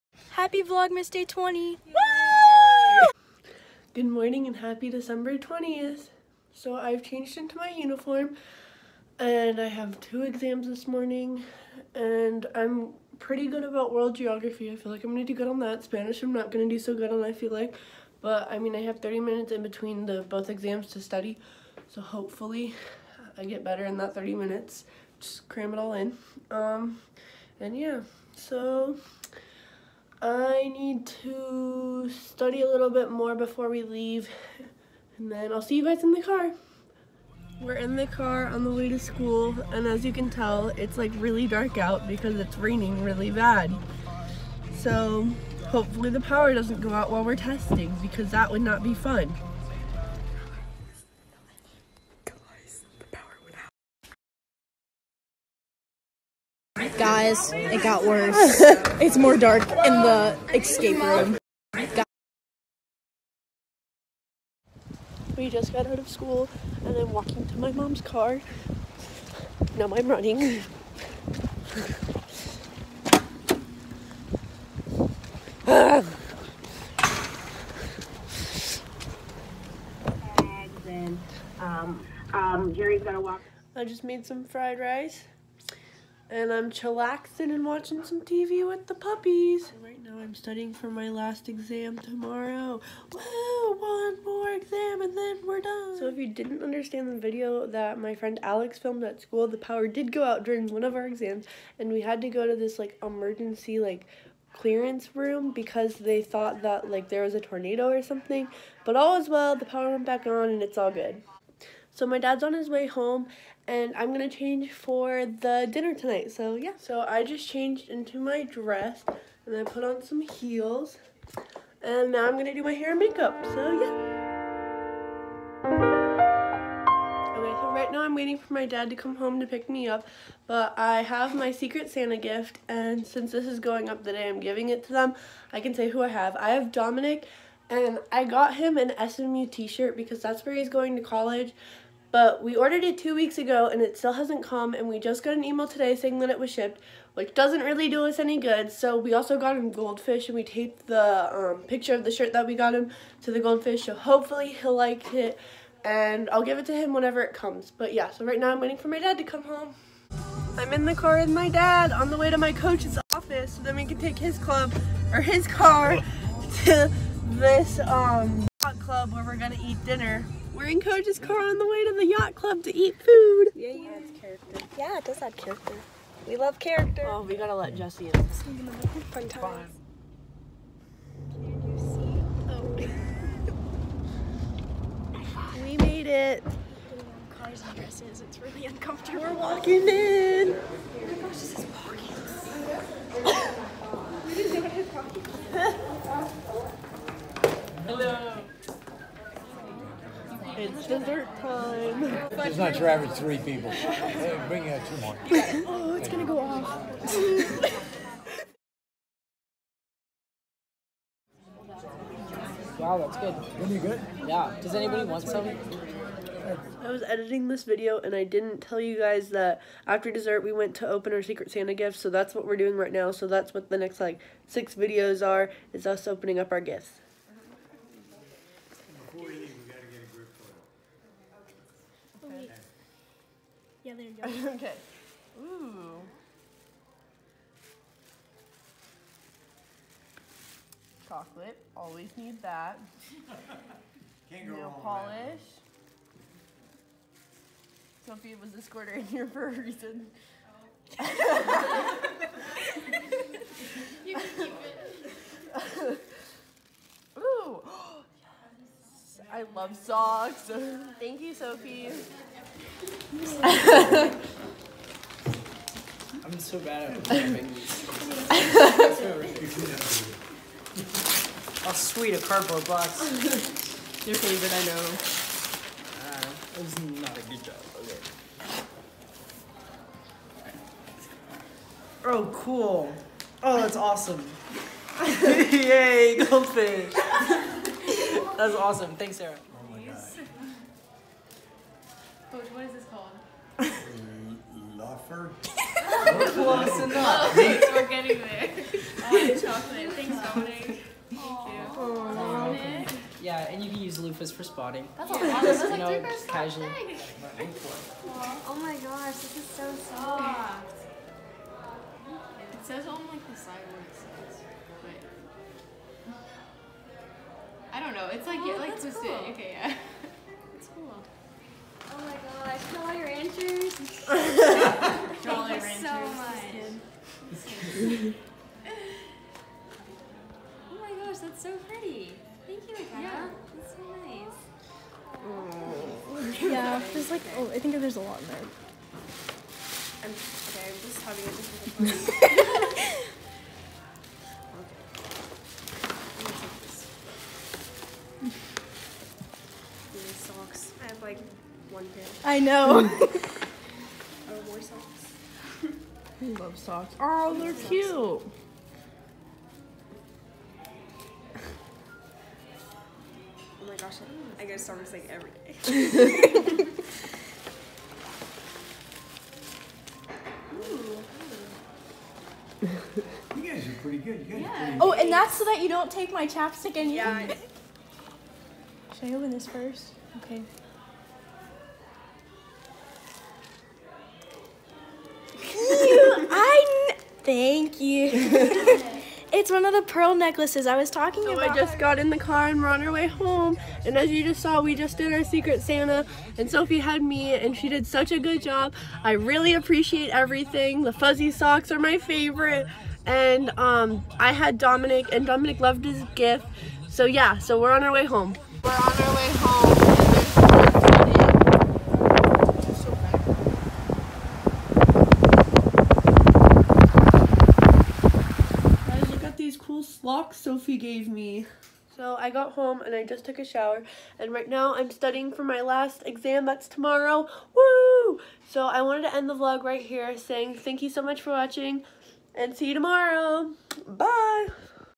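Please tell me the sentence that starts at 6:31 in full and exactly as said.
I just got in the car and we're on our way home.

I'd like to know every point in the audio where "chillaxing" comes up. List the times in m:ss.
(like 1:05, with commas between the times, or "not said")
1:26.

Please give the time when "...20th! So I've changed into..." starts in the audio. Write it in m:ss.
0:05.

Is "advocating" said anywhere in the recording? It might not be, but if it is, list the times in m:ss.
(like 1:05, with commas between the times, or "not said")
not said.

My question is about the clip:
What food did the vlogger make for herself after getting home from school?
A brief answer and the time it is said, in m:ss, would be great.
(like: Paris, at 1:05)
Fried rice, at 1:24.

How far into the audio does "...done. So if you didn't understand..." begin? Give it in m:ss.
1:35.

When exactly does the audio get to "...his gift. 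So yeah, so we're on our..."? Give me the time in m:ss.
6:45.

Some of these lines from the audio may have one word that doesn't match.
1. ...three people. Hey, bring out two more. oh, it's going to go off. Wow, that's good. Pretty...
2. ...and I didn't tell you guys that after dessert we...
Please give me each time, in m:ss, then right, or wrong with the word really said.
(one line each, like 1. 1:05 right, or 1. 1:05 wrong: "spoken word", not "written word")
1. 3:23 right
2. 3:37 right.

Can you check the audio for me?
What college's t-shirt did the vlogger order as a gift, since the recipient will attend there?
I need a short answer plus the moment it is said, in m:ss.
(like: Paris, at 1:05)
SMU, at 2:19.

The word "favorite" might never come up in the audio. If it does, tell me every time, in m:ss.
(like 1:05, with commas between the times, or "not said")
4:34, 6:41.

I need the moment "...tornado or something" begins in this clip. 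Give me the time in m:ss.
1:47.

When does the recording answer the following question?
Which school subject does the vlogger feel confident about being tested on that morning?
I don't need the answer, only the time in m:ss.
0:13.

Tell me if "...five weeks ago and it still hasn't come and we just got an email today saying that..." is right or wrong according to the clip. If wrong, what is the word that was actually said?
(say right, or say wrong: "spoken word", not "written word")
wrong: "two", not "five".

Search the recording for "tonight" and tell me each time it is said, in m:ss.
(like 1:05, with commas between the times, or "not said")
1:55.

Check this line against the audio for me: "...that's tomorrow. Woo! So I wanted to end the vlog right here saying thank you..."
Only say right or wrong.
right.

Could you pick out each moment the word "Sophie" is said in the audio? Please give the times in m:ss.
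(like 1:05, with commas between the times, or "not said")
4:08, 4:21, 6:36, 7:00.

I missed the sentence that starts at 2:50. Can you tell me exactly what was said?
We're in Coach's car on the way to the yacht club to eat food.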